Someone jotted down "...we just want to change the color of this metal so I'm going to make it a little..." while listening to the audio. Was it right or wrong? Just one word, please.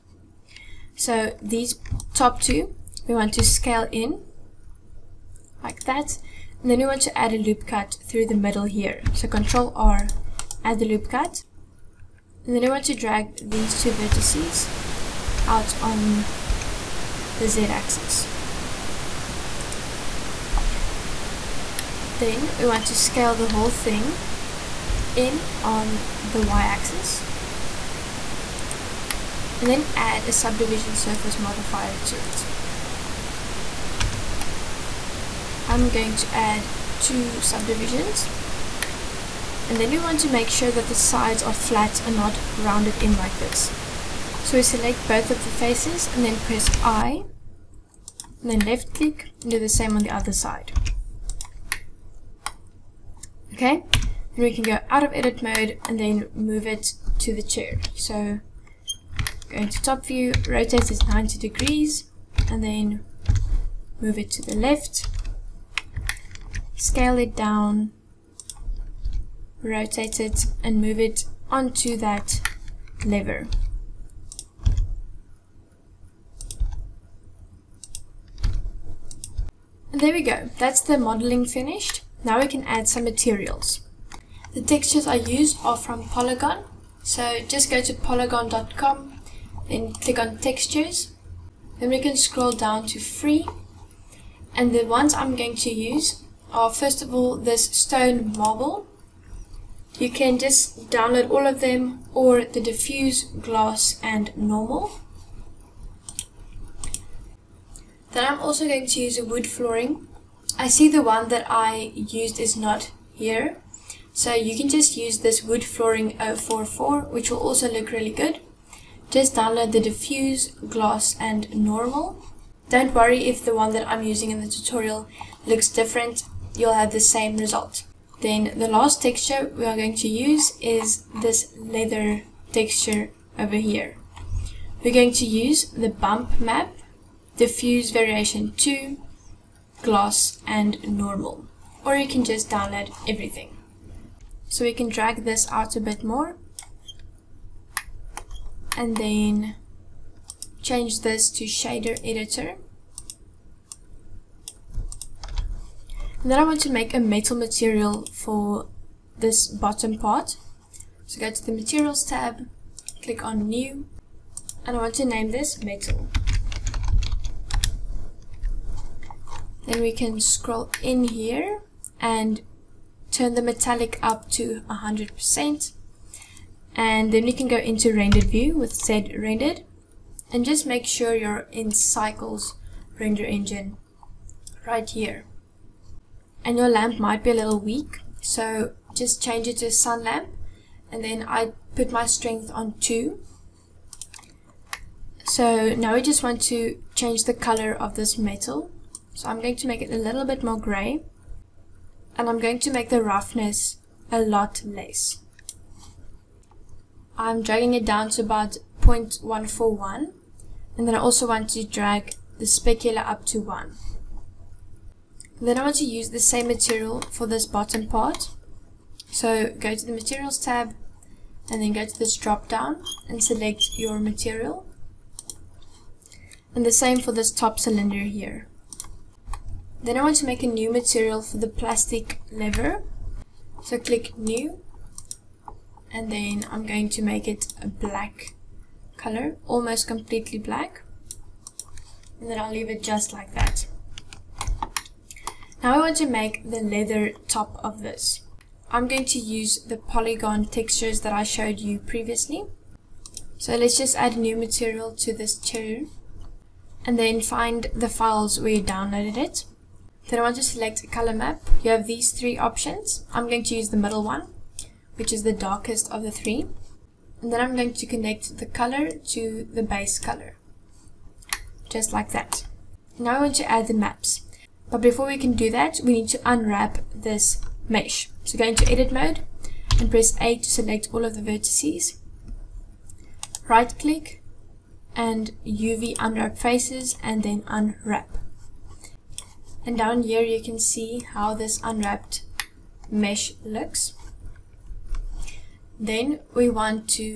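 right.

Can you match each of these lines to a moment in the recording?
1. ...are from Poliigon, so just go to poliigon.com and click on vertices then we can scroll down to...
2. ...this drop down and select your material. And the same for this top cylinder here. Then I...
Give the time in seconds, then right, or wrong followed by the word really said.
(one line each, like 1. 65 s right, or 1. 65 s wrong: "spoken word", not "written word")
1. 85 s wrong: "textures", not "vertices"
2. 221 s right.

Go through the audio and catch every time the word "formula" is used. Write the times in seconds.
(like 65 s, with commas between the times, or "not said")
not said.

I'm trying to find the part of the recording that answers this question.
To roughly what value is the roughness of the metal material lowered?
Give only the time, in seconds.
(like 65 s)
208 s.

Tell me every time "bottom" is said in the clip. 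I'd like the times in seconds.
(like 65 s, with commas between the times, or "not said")
159 s, 217 s.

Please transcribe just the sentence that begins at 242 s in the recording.
And then I'll leave it just like that.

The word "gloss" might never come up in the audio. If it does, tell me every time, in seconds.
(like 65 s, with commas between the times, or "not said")
103 s, 120 s, 139 s.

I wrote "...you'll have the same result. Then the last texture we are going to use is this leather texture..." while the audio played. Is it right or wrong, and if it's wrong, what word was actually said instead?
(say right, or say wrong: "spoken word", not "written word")
right.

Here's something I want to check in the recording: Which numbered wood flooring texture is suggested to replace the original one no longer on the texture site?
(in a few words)
Wood flooring 044.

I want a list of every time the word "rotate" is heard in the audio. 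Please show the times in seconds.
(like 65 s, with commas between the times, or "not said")
60 s, 69 s.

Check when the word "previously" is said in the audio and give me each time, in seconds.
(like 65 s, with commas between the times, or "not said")
251 s.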